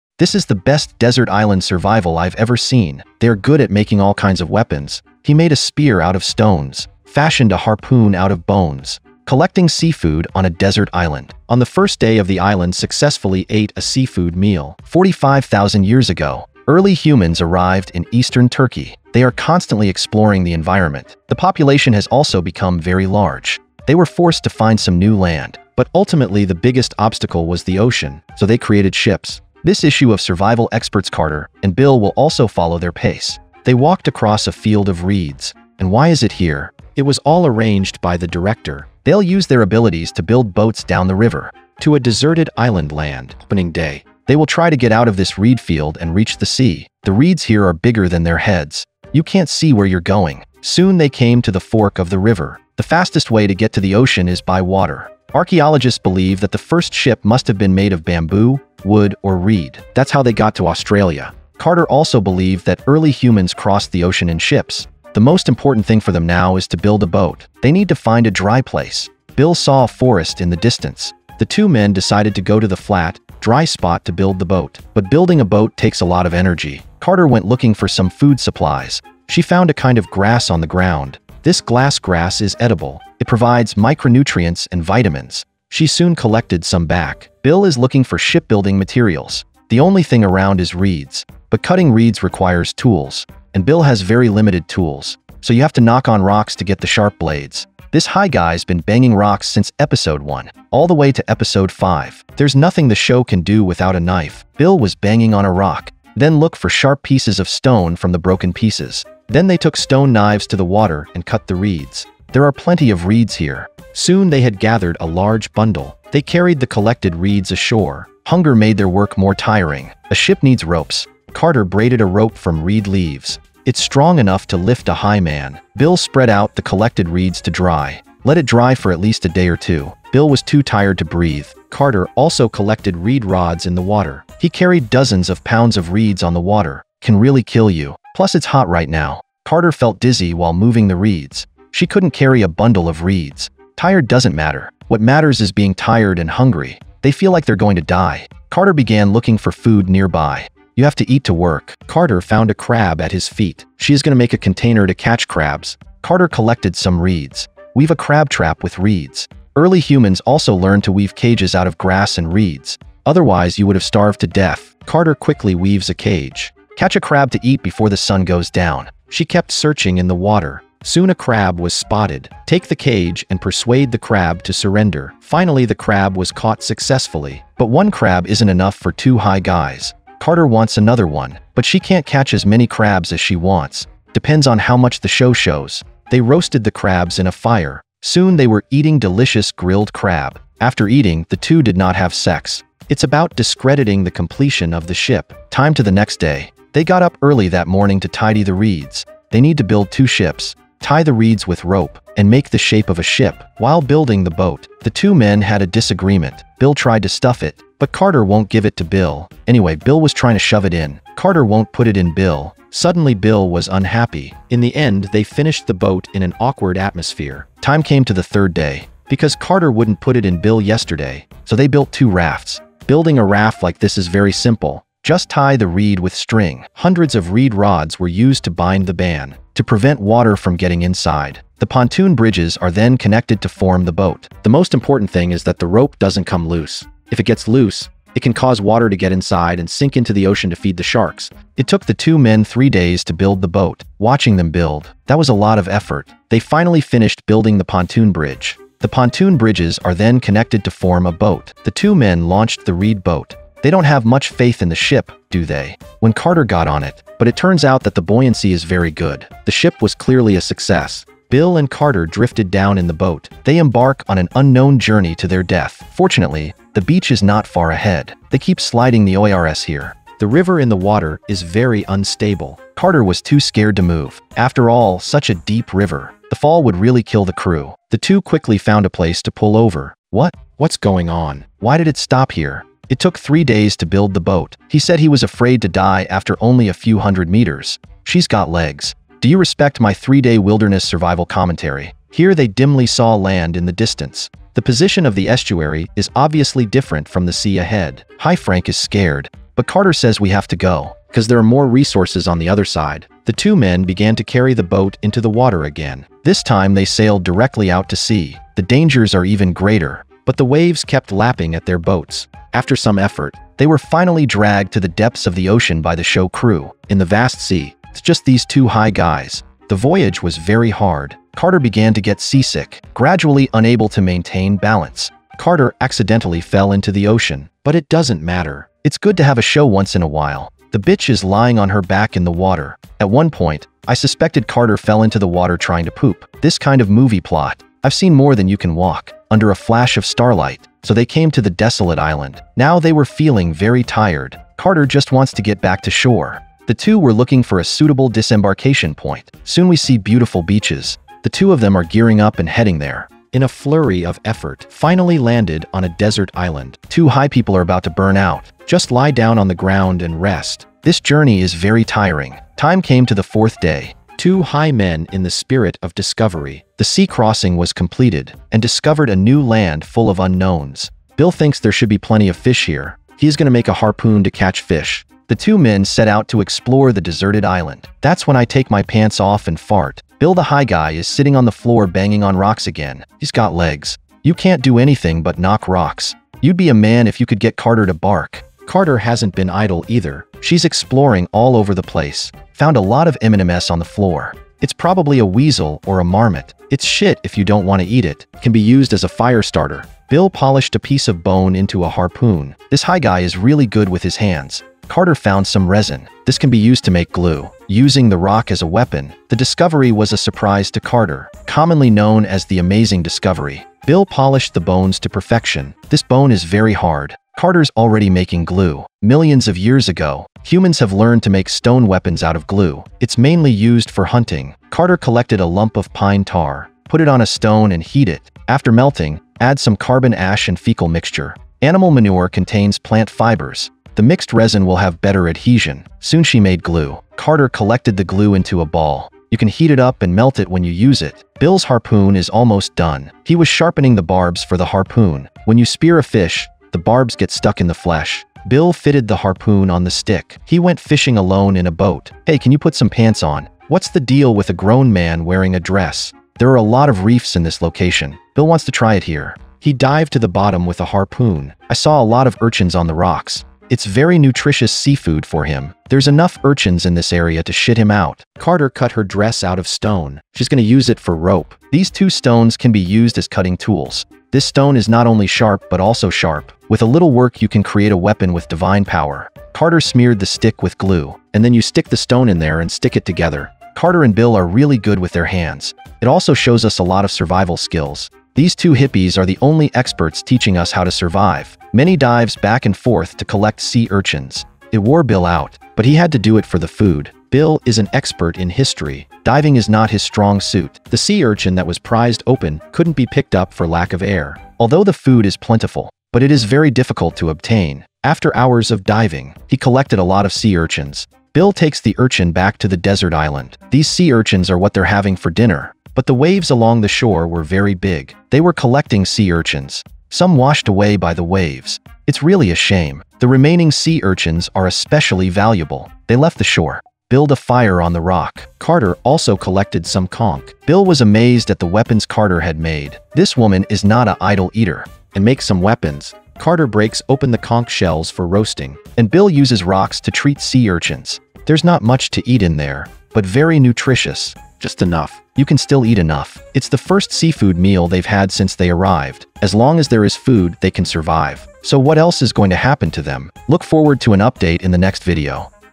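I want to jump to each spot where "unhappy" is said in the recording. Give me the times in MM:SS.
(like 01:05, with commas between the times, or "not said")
03:33.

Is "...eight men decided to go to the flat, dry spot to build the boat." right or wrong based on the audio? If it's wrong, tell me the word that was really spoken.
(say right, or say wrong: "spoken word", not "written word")
wrong: "two", not "eight".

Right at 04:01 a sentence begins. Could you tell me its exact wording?
It took the two men three days to build the boat.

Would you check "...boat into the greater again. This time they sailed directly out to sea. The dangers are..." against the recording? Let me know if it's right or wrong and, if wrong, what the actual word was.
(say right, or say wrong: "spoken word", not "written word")
wrong: "water", not "greater".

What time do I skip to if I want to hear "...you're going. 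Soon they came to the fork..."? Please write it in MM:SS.
00:49.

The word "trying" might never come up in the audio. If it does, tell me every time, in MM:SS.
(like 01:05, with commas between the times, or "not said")
03:30, 05:35.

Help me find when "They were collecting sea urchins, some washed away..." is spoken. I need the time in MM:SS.
08:38.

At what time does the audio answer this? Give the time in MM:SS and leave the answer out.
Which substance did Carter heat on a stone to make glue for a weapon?
07:05.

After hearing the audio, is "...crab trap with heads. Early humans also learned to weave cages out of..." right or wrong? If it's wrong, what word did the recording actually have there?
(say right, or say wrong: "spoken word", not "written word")
wrong: "reeds", not "heads".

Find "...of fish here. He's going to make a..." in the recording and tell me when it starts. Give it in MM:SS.
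06:12.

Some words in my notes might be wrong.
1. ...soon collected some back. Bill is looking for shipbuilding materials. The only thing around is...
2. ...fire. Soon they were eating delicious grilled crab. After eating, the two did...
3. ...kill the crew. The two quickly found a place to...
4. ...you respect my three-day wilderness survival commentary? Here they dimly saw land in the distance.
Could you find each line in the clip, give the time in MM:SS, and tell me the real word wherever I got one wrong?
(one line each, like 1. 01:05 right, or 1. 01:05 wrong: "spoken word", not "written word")
1. 01:25 right
2. 03:07 right
3. 04:37 right
4. 04:49 right.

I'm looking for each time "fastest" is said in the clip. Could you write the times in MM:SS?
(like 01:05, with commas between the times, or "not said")
00:52.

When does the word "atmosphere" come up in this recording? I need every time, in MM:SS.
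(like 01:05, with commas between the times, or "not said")
03:36.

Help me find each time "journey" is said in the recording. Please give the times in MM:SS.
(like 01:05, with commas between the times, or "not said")
04:24, 06:01.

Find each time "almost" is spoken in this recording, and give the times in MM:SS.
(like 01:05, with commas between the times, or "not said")
07:22.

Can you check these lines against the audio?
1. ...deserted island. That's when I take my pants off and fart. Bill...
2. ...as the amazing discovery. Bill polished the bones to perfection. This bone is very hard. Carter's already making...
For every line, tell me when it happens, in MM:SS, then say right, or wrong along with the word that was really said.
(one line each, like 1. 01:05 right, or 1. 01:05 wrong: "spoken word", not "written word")
1. 06:17 right
2. 06:52 right.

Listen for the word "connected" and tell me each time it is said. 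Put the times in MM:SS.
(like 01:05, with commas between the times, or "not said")
03:52, 04:10.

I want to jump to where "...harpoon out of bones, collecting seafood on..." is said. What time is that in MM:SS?
00:07.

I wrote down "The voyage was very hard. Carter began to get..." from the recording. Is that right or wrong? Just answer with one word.
right.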